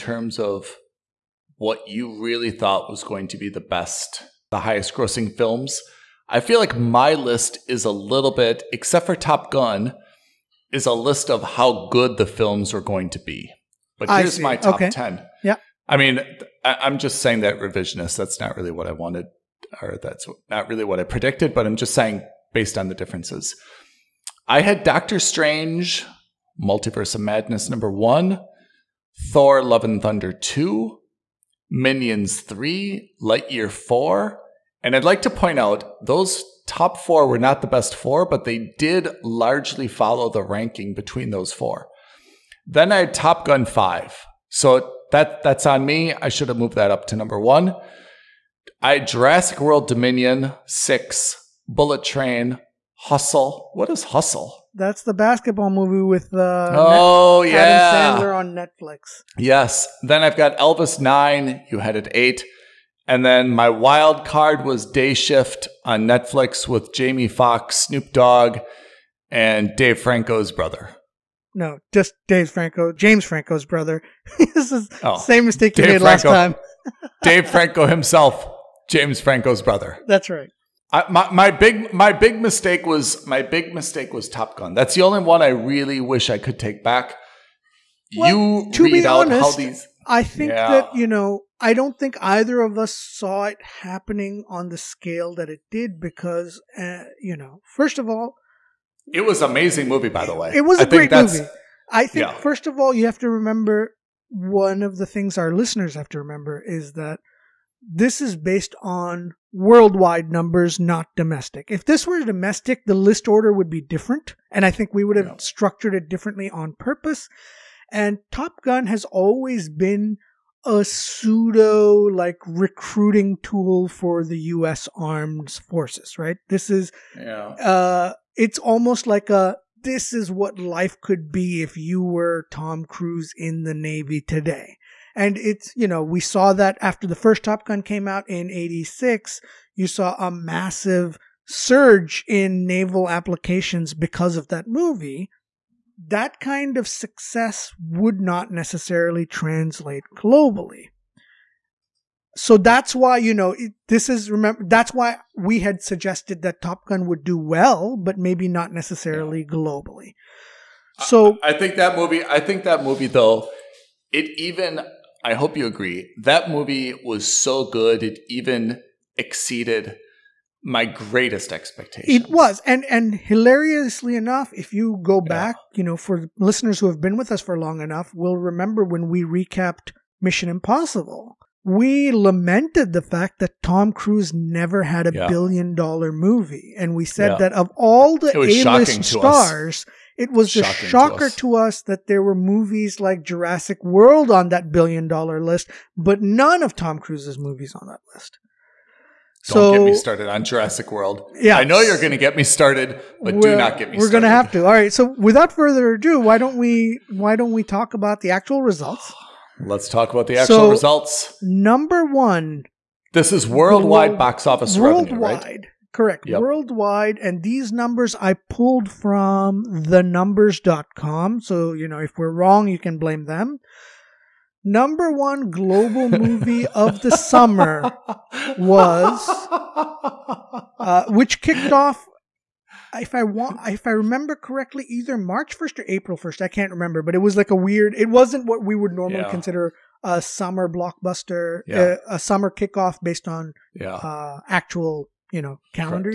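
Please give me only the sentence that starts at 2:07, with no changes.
uh it's almost like a this is what life could be if you were Tom Cruise in the Navy today.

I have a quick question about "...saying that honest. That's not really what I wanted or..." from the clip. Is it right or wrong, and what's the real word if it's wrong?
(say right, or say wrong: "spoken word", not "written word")
wrong: "revisionist", not "honest".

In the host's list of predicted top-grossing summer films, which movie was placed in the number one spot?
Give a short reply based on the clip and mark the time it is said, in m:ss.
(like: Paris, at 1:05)
Doctor Strange: Multiverse of Madness, at 0:24.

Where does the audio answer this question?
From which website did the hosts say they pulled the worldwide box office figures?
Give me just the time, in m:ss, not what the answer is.
3:39.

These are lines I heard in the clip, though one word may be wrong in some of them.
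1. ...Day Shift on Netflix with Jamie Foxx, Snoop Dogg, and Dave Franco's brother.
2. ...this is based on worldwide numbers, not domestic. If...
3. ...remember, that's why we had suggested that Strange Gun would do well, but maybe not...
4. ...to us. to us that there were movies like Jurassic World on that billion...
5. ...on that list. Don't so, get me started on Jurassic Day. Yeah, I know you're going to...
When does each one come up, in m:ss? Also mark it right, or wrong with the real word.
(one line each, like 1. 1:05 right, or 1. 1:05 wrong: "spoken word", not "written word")
1. 1:04 right
2. 1:47 right
3. 2:34 wrong: "Top", not "Strange"
4. 3:11 right
5. 3:17 wrong: "World", not "Day".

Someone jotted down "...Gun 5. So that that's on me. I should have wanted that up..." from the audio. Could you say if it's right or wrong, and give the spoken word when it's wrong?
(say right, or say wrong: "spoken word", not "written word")
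wrong: "moved", not "wanted".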